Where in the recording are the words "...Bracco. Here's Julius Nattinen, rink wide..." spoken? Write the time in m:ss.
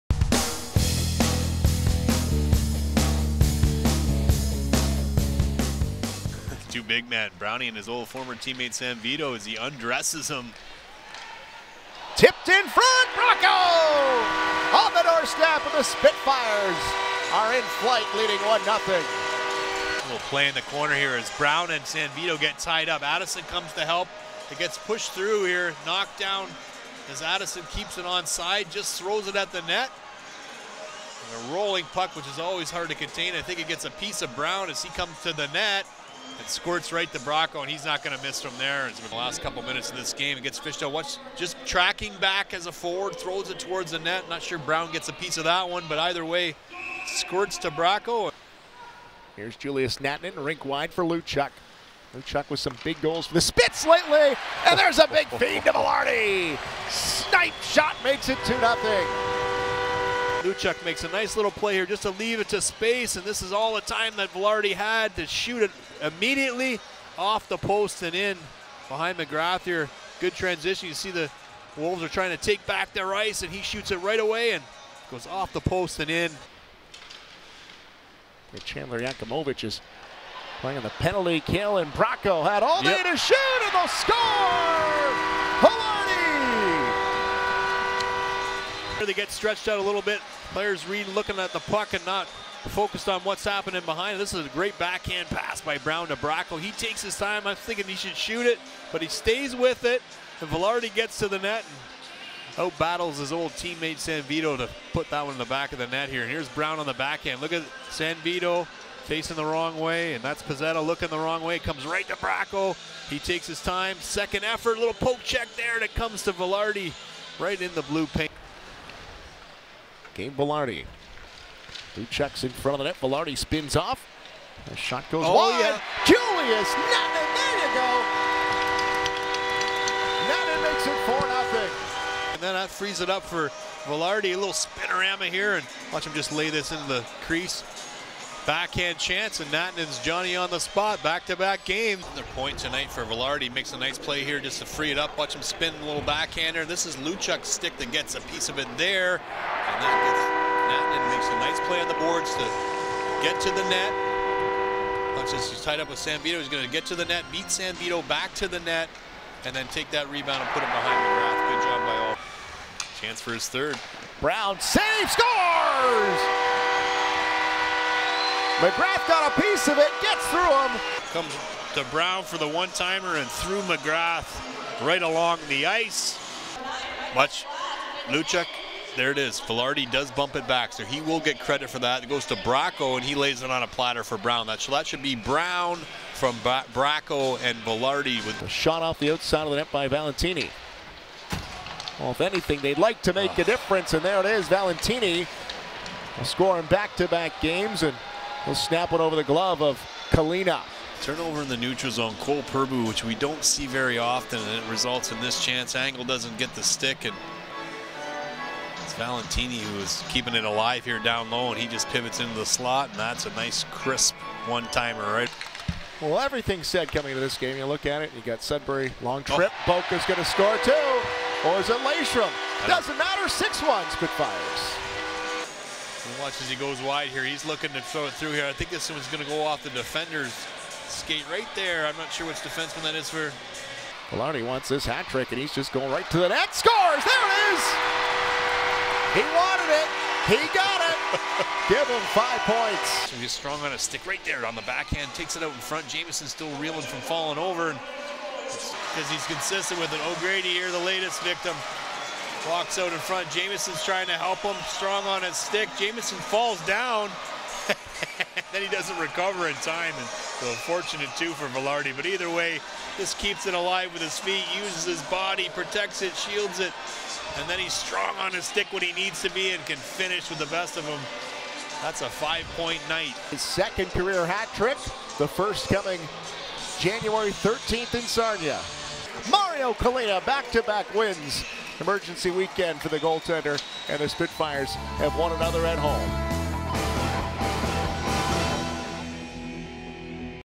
0:47.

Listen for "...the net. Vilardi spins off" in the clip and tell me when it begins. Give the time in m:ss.
2:02.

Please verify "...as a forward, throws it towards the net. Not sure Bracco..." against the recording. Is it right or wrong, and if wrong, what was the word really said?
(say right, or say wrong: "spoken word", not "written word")
wrong: "Brown", not "Bracco".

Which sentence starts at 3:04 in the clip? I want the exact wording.
That, that should be Brown from Bra Bracco and Velarde.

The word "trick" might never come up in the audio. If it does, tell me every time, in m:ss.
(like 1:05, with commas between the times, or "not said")
3:55, 4:34.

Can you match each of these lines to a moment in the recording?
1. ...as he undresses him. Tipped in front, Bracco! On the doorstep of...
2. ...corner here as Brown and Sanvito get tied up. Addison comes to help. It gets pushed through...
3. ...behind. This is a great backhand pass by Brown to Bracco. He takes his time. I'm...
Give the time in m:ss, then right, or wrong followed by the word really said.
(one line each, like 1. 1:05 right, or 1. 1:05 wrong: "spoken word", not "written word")
1. 0:09 right
2. 0:20 right
3. 1:33 right.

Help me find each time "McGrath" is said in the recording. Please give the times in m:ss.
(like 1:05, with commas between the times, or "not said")
1:09, 2:40, 2:48, 2:53.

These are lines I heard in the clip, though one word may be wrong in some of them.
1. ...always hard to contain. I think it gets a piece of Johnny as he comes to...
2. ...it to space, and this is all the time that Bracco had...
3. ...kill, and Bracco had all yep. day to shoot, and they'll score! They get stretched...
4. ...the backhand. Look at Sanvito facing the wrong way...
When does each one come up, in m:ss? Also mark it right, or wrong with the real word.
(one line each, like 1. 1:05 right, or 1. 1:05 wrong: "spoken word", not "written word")
1. 0:32 wrong: "Brown", not "Johnny"
2. 1:02 wrong: "Vilardi", not "Bracco"
3. 1:21 right
4. 1:46 right.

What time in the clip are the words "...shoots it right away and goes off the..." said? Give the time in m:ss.
1:13.